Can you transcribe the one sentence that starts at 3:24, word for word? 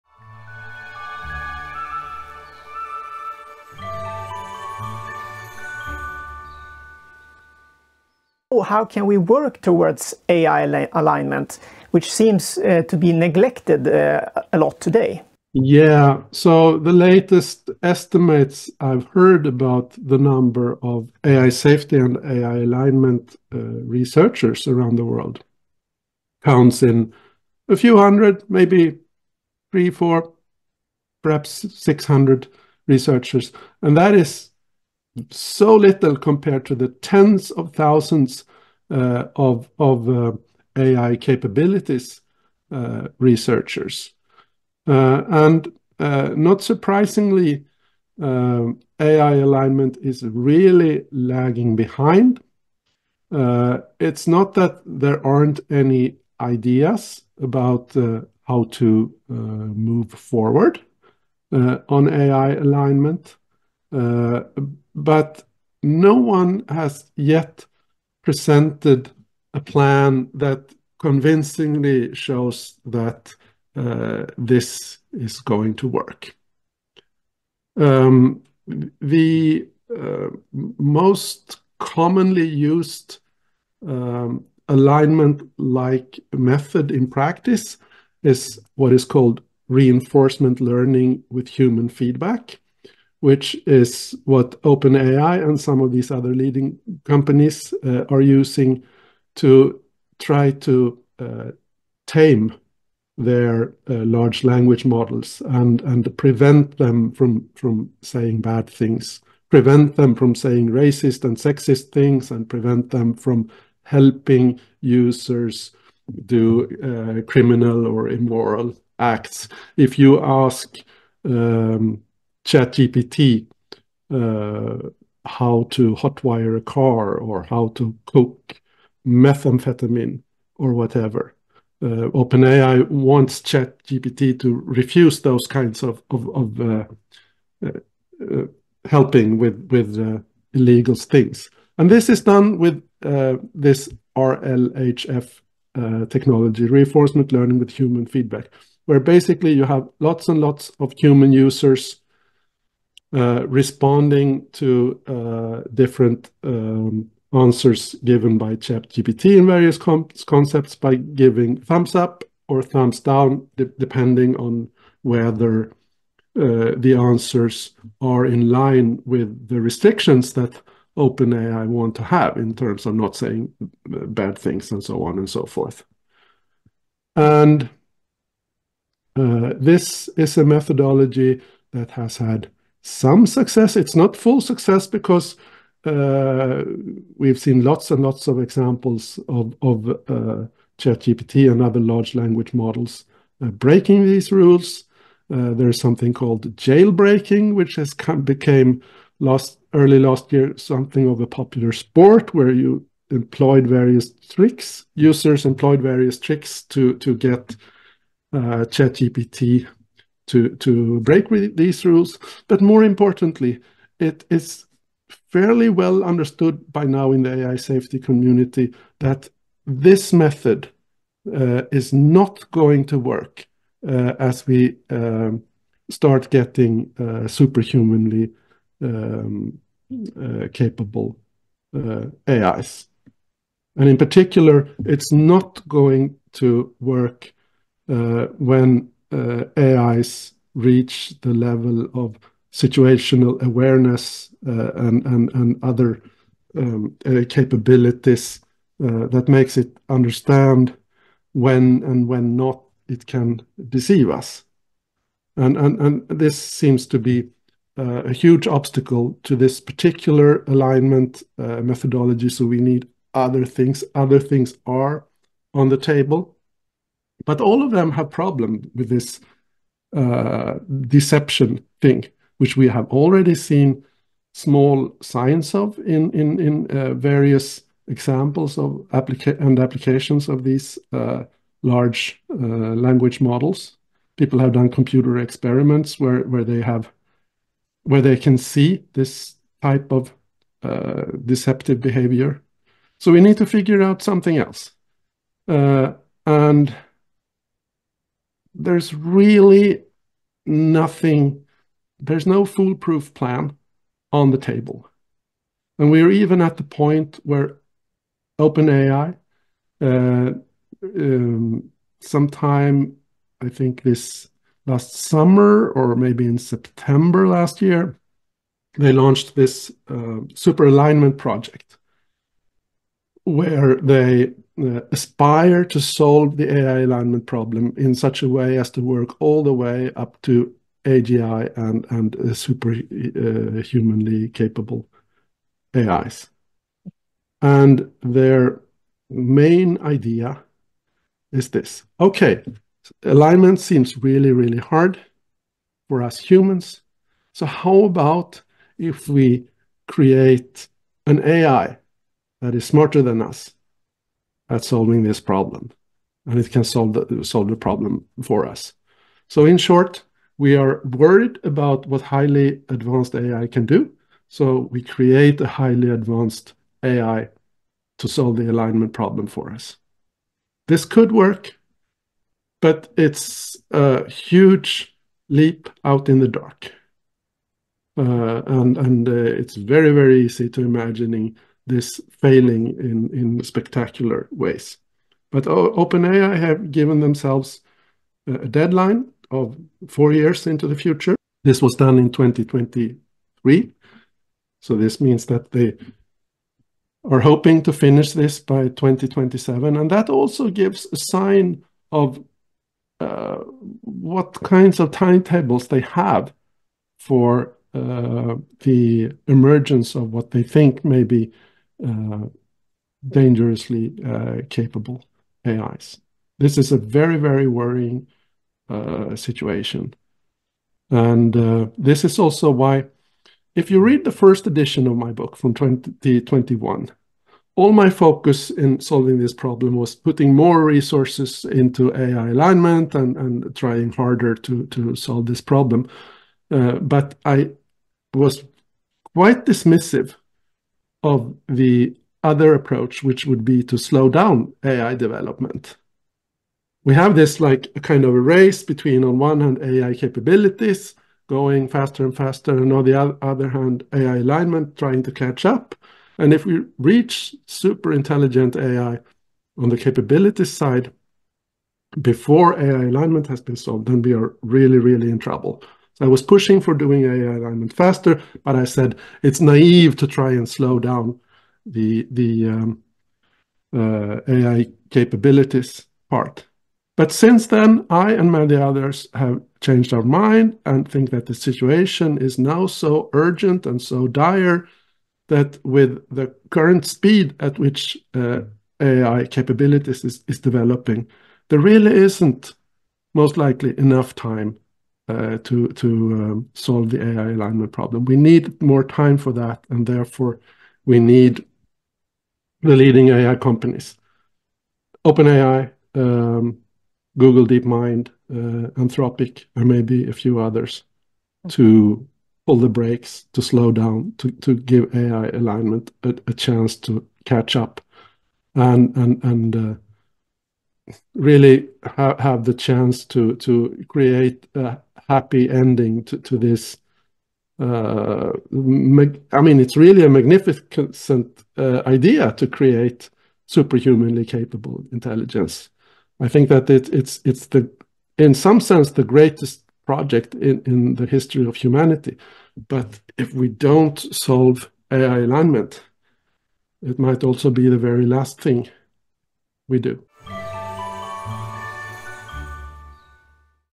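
Users employed various tricks to to get uh, ChatGPT to, to break these rules.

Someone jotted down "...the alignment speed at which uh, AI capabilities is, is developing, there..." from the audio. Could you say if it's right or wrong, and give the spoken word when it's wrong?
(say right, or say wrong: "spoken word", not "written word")
wrong: "current", not "alignment".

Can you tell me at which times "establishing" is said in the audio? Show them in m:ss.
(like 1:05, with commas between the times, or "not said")
not said.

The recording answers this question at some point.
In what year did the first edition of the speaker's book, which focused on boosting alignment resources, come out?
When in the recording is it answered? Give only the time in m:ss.
7:05.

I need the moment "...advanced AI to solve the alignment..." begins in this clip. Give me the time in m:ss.
6:05.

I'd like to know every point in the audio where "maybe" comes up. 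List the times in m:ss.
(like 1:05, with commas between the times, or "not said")
0:28, 5:15, 8:29.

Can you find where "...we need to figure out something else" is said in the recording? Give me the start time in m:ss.
4:53.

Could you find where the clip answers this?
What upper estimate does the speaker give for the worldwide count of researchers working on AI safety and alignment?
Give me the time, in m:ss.
0:31.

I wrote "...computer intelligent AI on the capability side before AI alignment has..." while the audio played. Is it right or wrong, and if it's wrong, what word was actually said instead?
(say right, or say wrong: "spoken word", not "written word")
wrong: "super", not "computer".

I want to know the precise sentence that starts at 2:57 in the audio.
And uh, this is a methodology that has had some success.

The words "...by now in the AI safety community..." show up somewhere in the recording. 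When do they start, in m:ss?
3:36.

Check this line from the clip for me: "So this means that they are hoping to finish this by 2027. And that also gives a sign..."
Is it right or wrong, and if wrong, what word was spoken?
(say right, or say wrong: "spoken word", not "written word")
right.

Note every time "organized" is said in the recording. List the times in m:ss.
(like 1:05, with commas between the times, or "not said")
not said.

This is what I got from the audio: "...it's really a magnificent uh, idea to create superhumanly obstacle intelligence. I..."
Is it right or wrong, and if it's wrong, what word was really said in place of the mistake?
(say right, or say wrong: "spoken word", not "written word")
wrong: "capable", not "obstacle".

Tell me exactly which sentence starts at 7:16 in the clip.
Uh, but I was quite dismissive of the other approach, which would be to slow down AI development.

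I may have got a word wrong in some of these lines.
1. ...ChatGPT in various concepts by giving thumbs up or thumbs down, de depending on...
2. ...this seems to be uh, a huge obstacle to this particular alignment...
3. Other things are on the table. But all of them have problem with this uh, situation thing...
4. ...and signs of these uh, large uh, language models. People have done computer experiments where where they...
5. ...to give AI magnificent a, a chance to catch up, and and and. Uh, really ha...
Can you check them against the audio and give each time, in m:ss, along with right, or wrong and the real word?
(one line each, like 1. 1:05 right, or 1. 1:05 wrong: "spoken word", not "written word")
1. 2:38 right
2. 4:16 right
3. 4:23 wrong: "deception", not "situation"
4. 4:39 wrong: "applications", not "signs"
5. 8:34 wrong: "alignment", not "magnificent".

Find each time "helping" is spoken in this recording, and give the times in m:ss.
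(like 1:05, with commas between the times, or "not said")
1:53, 2:18.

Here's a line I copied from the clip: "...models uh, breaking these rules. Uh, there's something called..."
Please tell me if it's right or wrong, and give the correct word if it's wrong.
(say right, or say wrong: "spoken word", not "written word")
right.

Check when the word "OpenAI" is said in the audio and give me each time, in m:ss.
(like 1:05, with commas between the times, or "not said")
1:34, 2:12, 2:50, 5:08, 6:25, 8:25.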